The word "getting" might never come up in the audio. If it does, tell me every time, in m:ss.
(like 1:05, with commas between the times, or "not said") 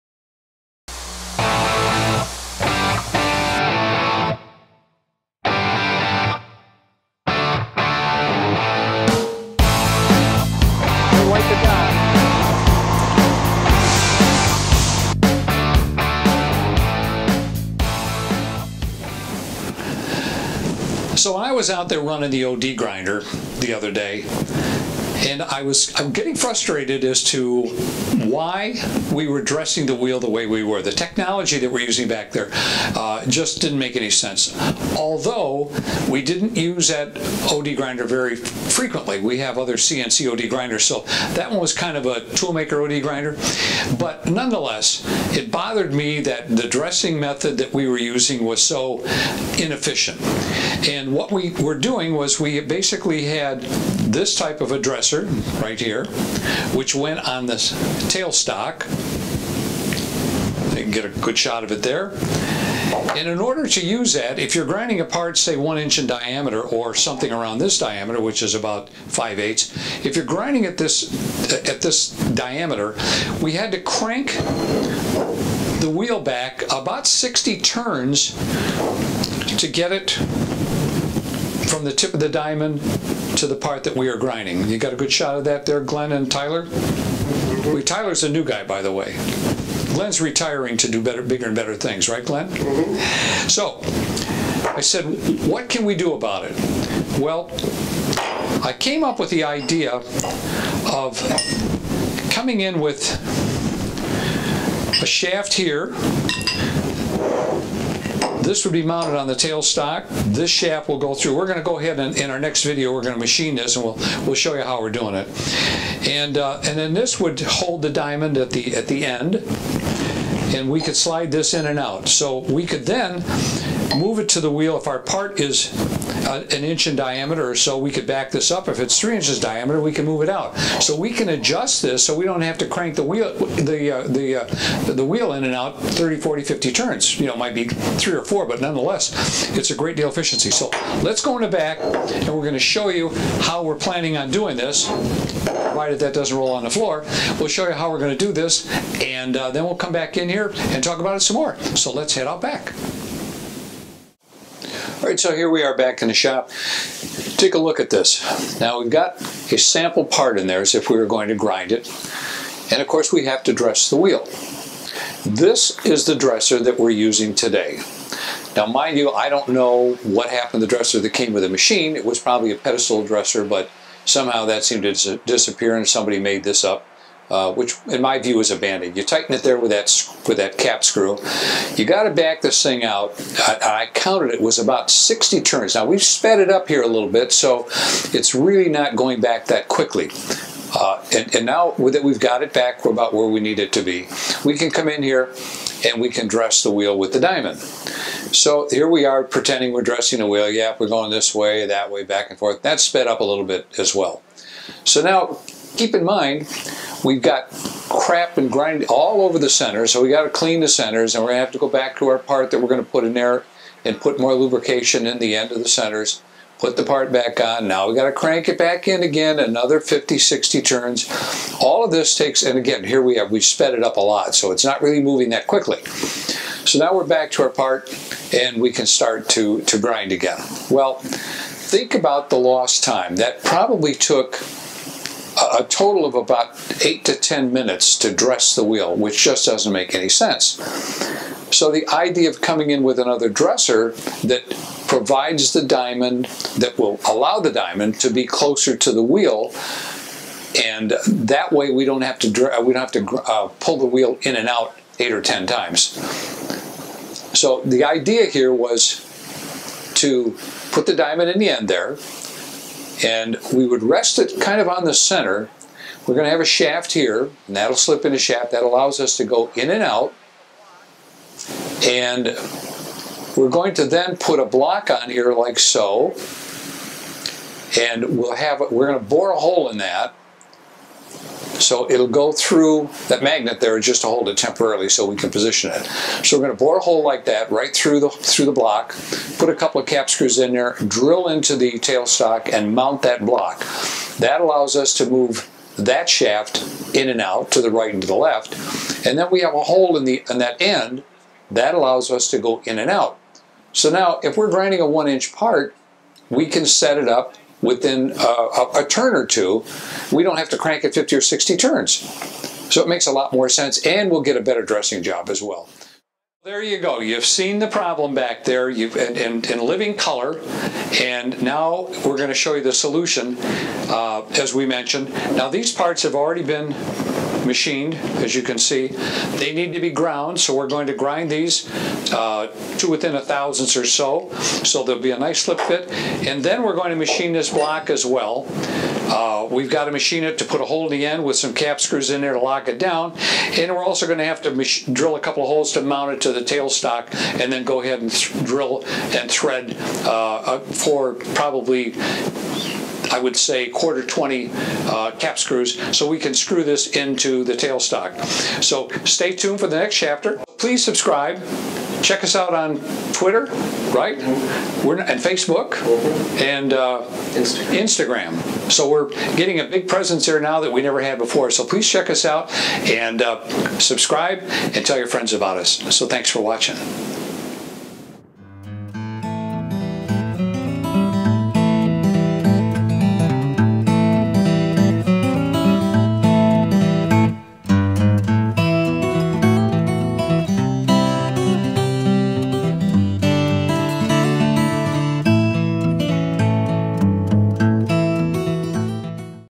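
0:26, 6:09.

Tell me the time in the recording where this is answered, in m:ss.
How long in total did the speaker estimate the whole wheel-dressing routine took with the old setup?
3:56.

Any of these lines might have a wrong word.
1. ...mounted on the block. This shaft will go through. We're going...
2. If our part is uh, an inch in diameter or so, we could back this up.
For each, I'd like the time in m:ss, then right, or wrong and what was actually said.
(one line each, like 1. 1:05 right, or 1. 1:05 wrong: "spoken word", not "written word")
1. 1:48 wrong: "tailstock", not "block"
2. 2:04 right.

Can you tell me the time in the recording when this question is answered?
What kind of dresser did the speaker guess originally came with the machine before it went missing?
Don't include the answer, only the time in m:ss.
2:52.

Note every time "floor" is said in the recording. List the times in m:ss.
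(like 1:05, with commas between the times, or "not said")
2:26.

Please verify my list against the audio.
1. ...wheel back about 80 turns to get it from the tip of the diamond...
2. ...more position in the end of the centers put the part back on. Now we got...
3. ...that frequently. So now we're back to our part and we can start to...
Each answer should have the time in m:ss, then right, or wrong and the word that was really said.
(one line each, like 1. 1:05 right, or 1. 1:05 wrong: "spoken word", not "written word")
1. 1:15 wrong: "60", not "80"
2. 3:34 wrong: "lubrication", not "position"
3. 3:45 wrong: "quickly", not "frequently".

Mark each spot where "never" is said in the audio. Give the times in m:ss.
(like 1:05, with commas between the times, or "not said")
6:10.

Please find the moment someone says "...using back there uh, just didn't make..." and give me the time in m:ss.
0:31.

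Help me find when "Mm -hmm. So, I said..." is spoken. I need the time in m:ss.
1:32.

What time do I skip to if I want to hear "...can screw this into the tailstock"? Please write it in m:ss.
5:56.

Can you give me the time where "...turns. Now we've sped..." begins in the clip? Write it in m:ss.
3:05.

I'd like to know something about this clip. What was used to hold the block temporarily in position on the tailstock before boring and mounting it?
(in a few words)
magnet.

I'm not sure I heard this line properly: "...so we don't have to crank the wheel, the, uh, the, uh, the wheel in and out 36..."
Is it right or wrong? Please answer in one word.
wrong.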